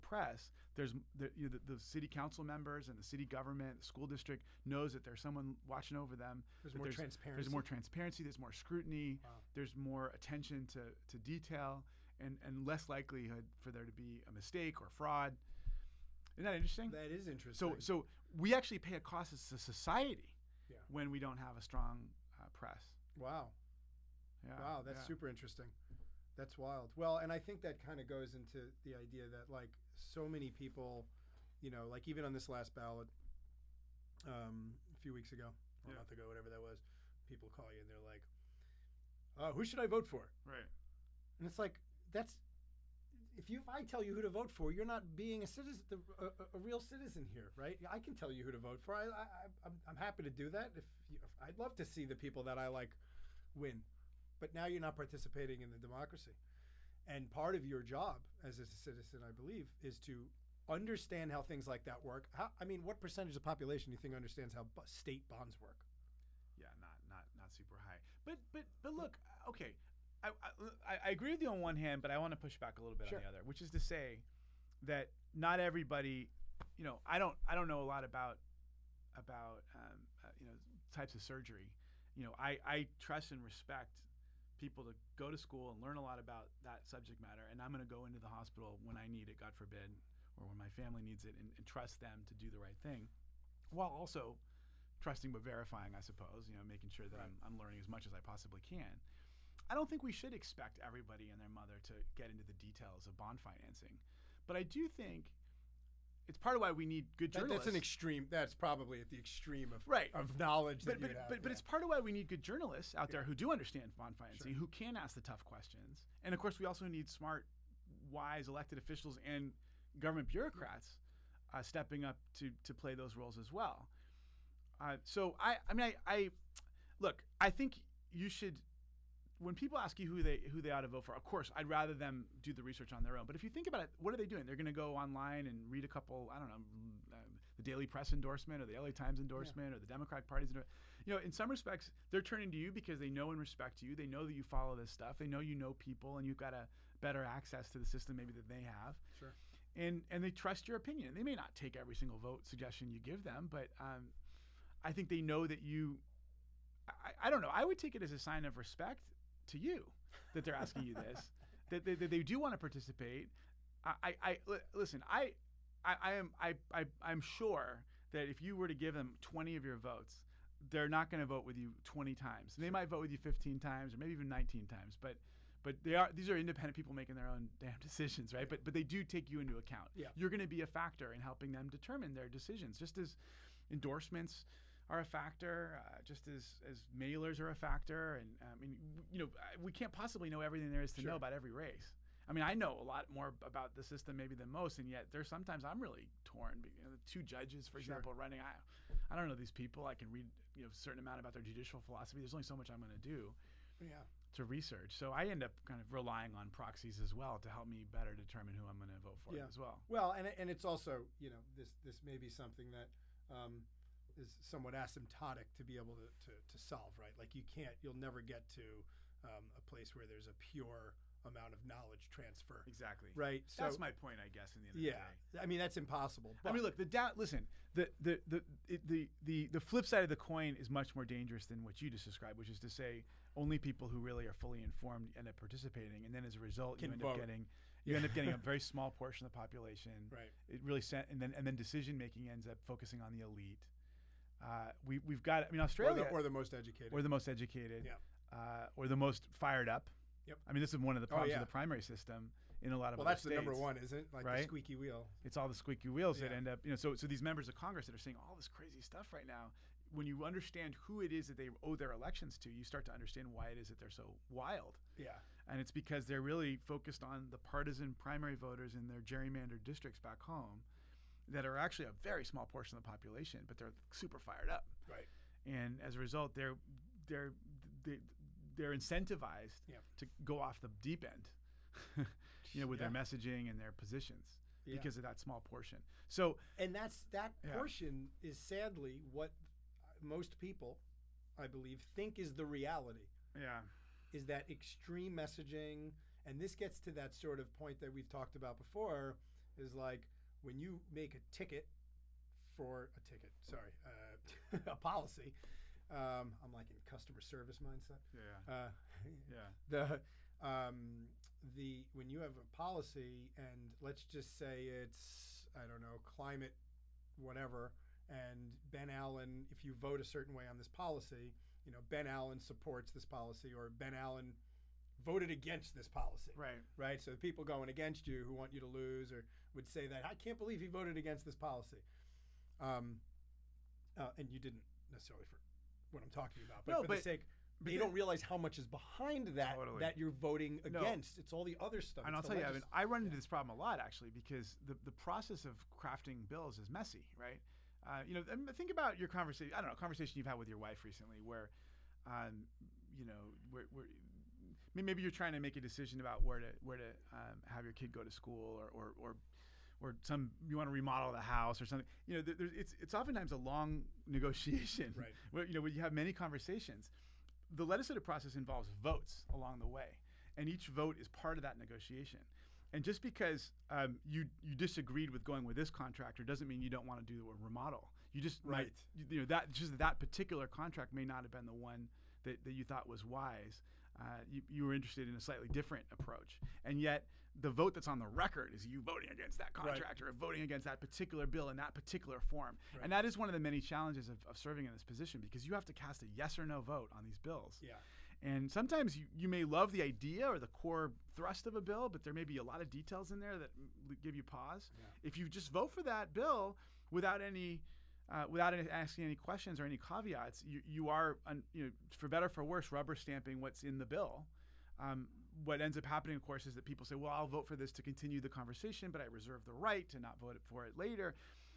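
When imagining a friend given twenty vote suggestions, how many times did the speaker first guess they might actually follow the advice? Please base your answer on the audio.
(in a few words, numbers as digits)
15.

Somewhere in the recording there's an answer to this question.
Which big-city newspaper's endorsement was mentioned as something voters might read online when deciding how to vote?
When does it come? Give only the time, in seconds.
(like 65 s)
138 s.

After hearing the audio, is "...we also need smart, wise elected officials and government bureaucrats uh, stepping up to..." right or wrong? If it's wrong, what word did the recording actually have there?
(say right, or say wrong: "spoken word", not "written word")
right.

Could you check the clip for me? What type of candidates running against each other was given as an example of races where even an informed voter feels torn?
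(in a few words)
judges.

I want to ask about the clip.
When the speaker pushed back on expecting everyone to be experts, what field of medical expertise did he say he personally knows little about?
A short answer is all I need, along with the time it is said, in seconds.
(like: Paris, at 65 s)
surgery, at 80 s.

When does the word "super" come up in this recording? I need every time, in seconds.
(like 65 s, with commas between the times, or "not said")
25 s, 67 s, 273 s.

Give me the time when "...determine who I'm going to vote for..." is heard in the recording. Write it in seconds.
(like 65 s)
208 s.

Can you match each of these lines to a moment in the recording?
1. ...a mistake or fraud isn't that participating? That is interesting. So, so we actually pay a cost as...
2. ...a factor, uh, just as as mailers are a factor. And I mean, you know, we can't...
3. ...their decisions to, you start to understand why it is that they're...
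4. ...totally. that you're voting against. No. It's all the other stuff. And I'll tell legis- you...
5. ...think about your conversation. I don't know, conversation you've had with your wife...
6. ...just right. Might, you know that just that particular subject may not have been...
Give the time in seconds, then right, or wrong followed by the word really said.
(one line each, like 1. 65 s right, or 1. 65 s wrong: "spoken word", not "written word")
1. 14 s wrong: "interesting", not "participating"
2. 184 s right
3. 261 s wrong: "elections", not "decisions"
4. 339 s right
5. 348 s right
6. 378 s wrong: "contract", not "subject".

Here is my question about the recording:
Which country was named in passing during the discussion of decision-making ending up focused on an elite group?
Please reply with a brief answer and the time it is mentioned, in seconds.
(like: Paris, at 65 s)
Australia, at 245 s.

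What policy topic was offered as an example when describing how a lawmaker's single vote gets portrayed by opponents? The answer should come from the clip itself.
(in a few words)
climate.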